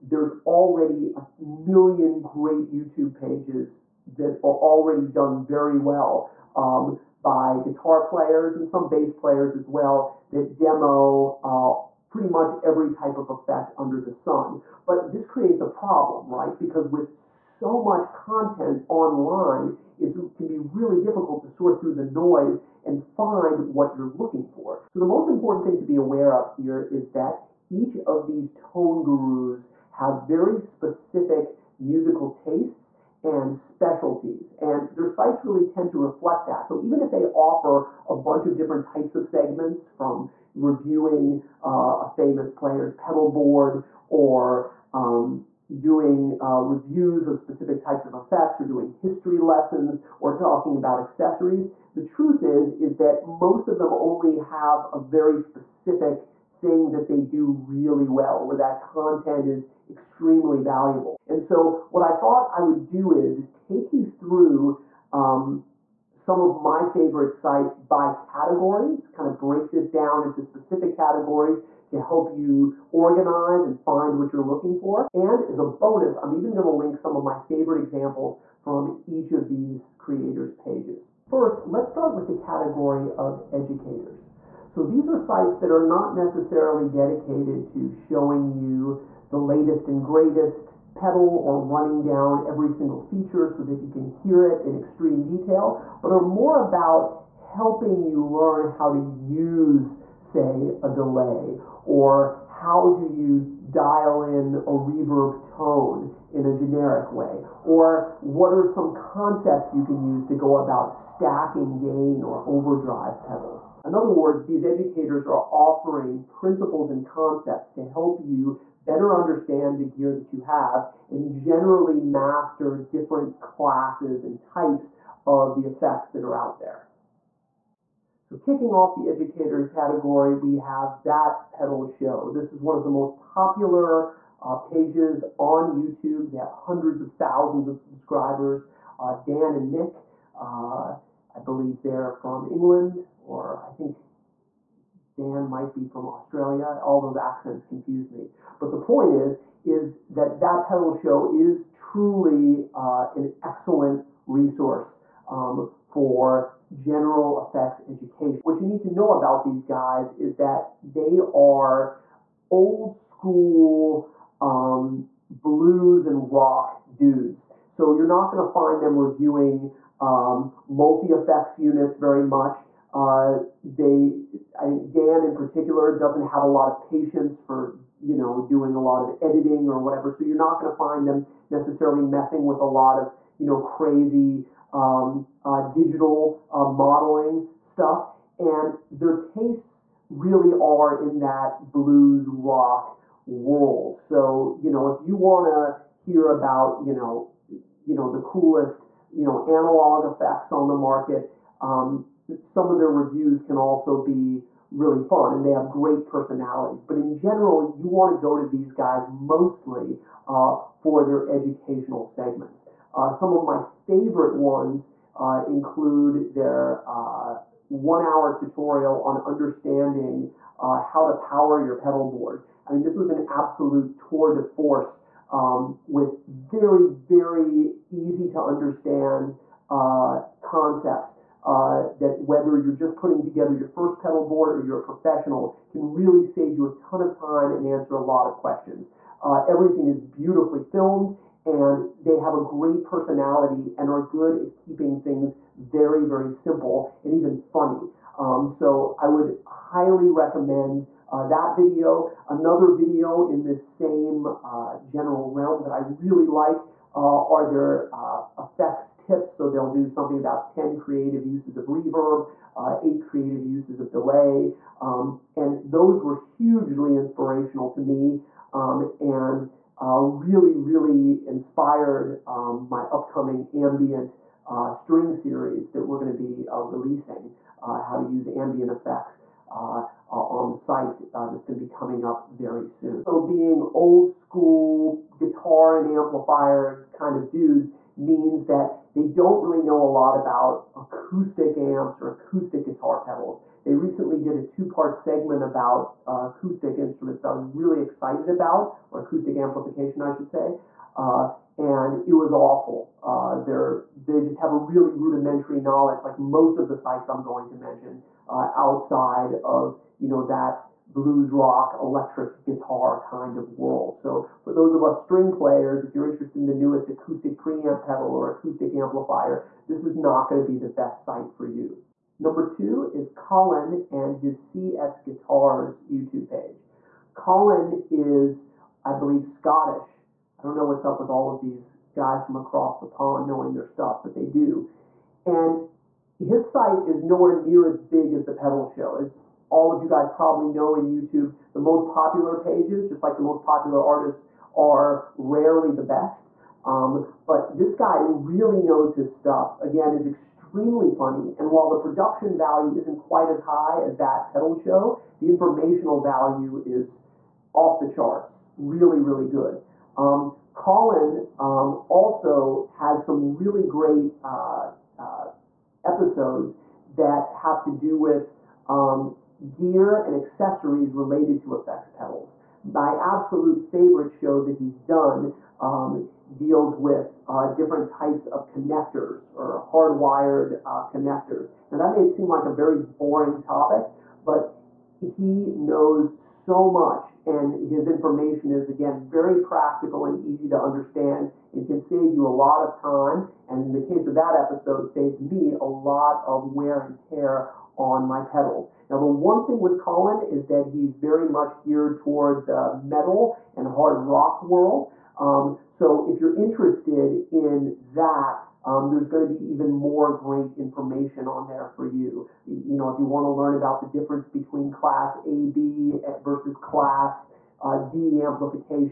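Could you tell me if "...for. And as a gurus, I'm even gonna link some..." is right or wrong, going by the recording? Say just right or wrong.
wrong.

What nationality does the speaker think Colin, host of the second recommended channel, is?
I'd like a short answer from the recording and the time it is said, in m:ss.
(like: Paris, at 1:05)
Scottish, at 5:29.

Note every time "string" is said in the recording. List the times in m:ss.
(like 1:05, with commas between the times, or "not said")
4:34, 5:15.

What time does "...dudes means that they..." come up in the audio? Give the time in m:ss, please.
4:47.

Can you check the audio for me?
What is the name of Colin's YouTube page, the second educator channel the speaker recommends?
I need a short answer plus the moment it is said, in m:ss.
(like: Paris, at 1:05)
CS Guitars, at 5:24.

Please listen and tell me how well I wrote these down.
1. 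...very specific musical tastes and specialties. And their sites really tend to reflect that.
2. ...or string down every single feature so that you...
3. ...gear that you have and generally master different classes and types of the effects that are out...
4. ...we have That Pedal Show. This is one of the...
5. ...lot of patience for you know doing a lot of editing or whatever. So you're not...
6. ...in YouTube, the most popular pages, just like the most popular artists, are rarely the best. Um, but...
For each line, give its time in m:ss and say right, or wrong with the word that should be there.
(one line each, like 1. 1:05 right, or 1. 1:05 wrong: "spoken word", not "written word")
1. 0:30 right
2. 1:31 wrong: "running", not "string"
3. 1:59 right
4. 2:10 right
5. 2:56 right
6. 5:40 right.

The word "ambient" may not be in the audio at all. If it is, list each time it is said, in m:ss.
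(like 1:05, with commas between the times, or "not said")
4:33, 4:38.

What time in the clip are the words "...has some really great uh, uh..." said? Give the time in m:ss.
6:02.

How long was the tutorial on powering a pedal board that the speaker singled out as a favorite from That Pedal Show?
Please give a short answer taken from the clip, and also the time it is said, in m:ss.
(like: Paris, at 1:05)
1 hour, at 3:37.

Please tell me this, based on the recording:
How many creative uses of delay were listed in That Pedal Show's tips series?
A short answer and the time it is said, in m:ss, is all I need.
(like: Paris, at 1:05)
8, at 4:22.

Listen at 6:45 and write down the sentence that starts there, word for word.
Um, so if you're interested in that, um, there's going to be even more great information on there for you.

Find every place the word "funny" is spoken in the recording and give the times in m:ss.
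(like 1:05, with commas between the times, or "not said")
4:07, 5:50.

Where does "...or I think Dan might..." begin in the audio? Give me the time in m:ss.
2:23.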